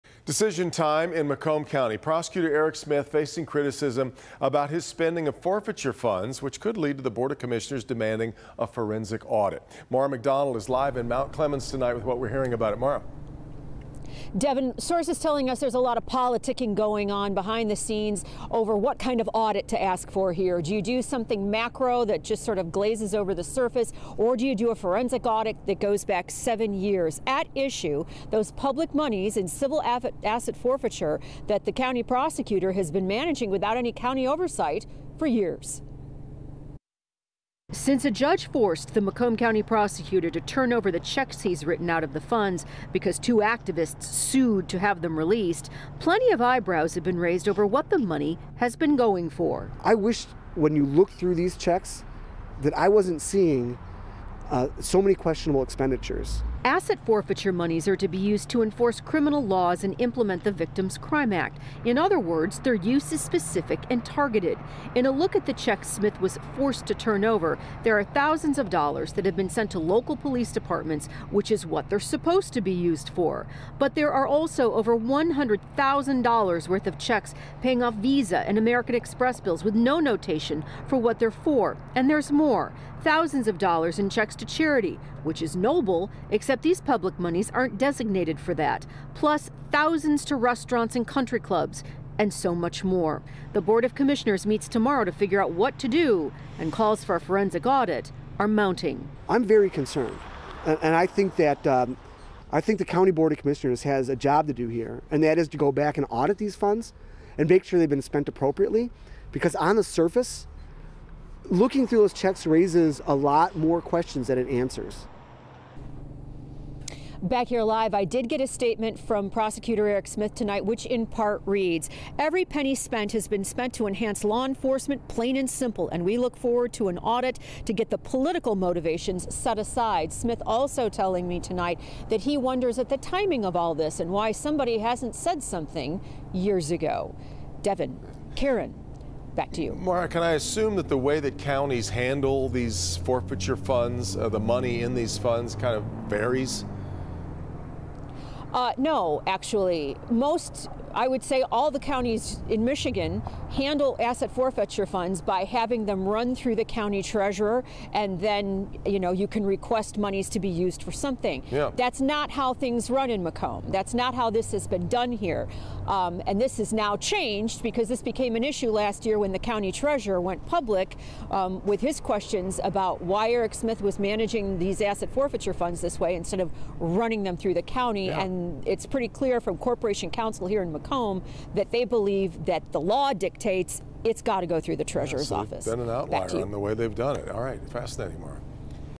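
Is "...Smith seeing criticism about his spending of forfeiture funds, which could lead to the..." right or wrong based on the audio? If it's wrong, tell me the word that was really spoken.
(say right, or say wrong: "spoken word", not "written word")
wrong: "facing", not "seeing".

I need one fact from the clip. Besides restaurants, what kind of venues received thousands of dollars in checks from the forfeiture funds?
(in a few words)
country clubs.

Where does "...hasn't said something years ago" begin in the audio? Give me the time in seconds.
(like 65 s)
134 s.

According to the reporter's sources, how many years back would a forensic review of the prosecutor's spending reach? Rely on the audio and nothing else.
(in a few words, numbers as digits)
7 years.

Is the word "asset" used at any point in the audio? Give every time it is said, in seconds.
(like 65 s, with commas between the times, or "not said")
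29 s, 56 s, 153 s, 174 s.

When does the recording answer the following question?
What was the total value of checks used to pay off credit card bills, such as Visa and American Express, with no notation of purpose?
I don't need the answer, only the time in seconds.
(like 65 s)
74 s.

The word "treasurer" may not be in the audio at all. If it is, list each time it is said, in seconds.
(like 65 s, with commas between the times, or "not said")
157 s, 169 s, 184 s.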